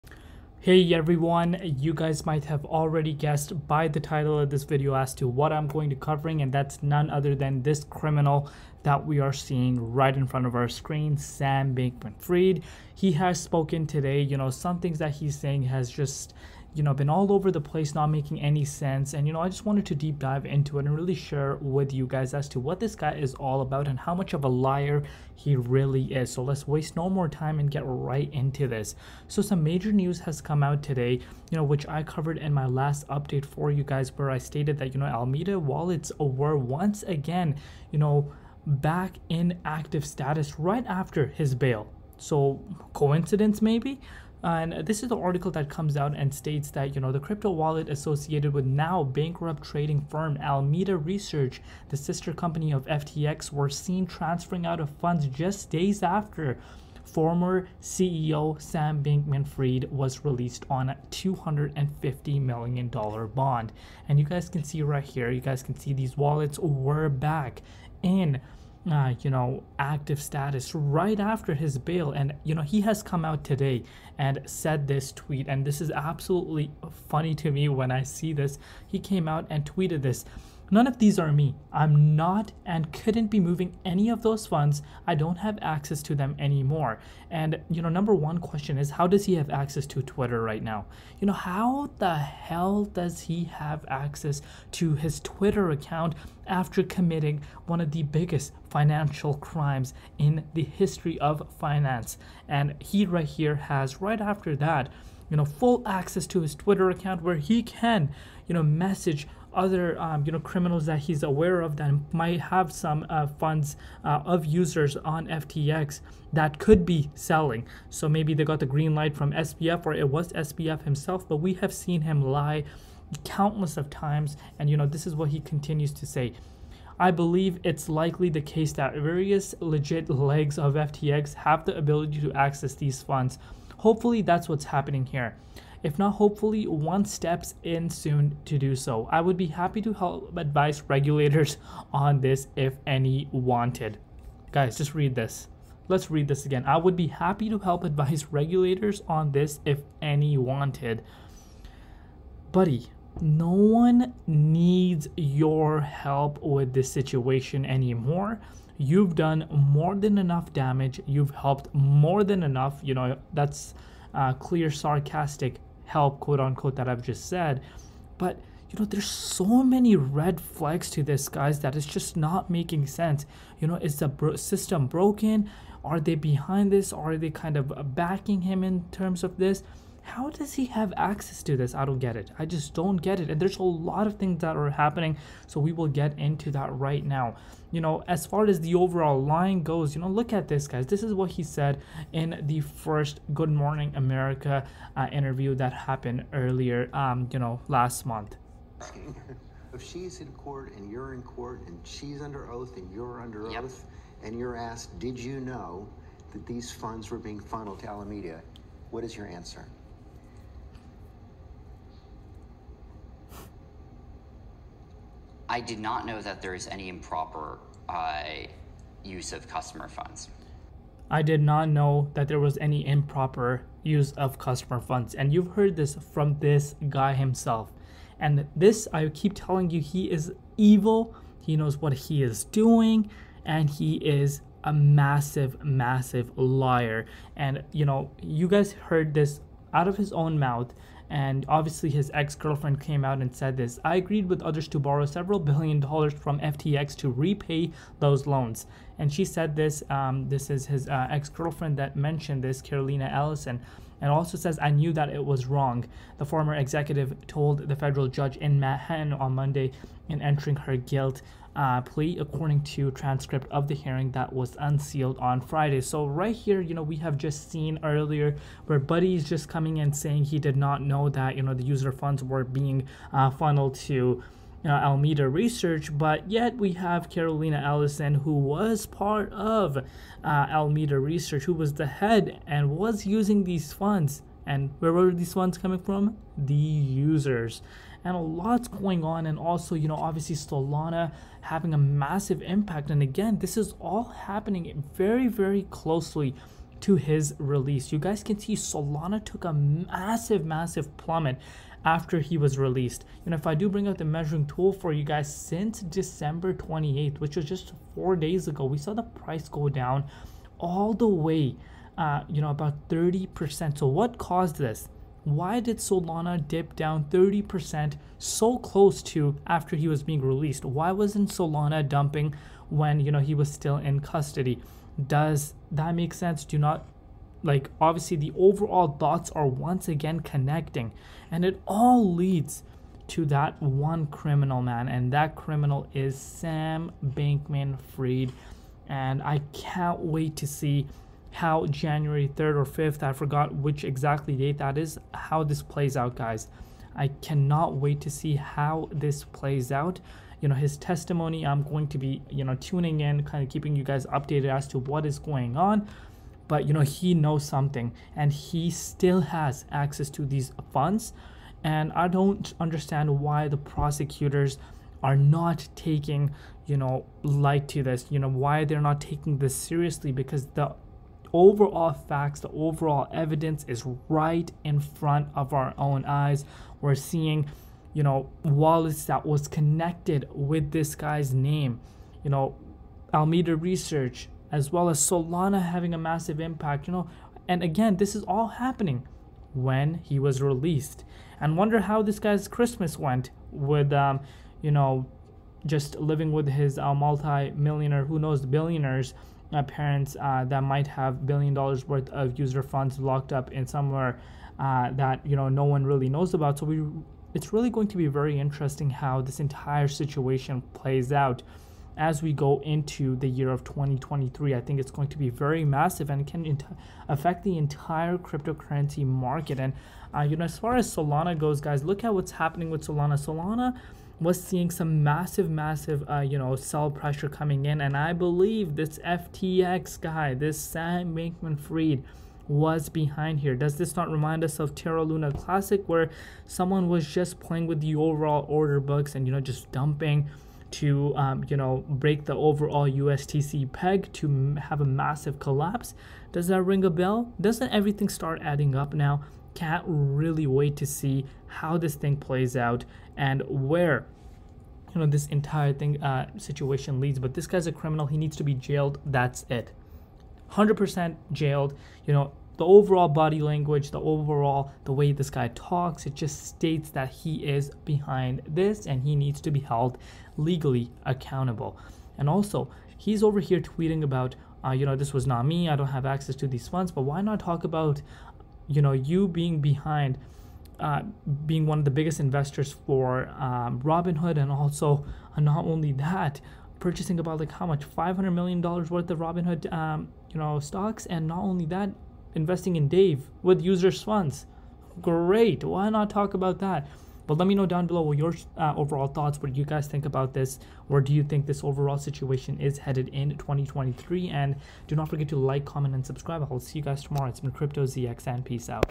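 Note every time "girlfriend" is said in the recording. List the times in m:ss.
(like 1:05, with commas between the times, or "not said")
4:02, 4:11.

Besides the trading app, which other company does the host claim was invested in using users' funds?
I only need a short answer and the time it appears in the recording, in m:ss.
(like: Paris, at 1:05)
Dave, at 8:12.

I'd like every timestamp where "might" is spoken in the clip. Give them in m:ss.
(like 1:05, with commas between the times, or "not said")
0:02, 1:52, 6:40.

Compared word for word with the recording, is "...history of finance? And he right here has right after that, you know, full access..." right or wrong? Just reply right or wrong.
right.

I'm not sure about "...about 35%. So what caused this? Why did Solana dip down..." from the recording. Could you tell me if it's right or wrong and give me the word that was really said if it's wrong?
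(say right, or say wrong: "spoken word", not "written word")
wrong: "30", not "35".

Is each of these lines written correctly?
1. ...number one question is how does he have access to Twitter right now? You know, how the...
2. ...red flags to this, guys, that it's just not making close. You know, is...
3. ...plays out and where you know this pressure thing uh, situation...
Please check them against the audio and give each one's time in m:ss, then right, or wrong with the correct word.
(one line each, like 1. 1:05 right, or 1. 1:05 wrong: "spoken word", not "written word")
1. 1:27 right
2. 2:49 wrong: "sense", not "close"
3. 7:32 wrong: "entire", not "pressure".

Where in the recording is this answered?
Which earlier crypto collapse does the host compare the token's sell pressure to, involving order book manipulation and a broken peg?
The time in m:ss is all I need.
7:14.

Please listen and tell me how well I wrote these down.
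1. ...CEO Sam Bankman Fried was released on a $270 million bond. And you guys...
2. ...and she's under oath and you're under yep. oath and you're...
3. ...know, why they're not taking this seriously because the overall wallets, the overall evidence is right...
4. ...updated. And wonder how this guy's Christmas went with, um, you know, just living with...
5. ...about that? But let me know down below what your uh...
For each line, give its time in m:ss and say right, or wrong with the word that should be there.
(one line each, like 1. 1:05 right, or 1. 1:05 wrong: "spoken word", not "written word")
1. 0:57 wrong: "250", not "270"
2. 3:21 right
3. 6:08 wrong: "facts", not "wallets"
4. 6:30 wrong: "released", not "updated"
5. 8:16 right.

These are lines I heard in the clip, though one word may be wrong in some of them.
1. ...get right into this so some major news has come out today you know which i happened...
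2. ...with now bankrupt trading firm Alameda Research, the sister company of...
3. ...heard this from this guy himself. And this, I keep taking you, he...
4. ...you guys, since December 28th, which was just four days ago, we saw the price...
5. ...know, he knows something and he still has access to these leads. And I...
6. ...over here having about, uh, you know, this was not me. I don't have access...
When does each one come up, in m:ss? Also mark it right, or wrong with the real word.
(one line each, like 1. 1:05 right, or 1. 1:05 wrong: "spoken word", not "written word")
1. 0:27 wrong: "covered", not "happened"
2. 0:48 right
3. 3:45 wrong: "telling", not "taking"
4. 5:04 right
5. 5:56 wrong: "funds", not "leads"
6. 7:53 wrong: "tweeting", not "having".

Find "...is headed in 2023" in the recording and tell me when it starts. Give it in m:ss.
8:22.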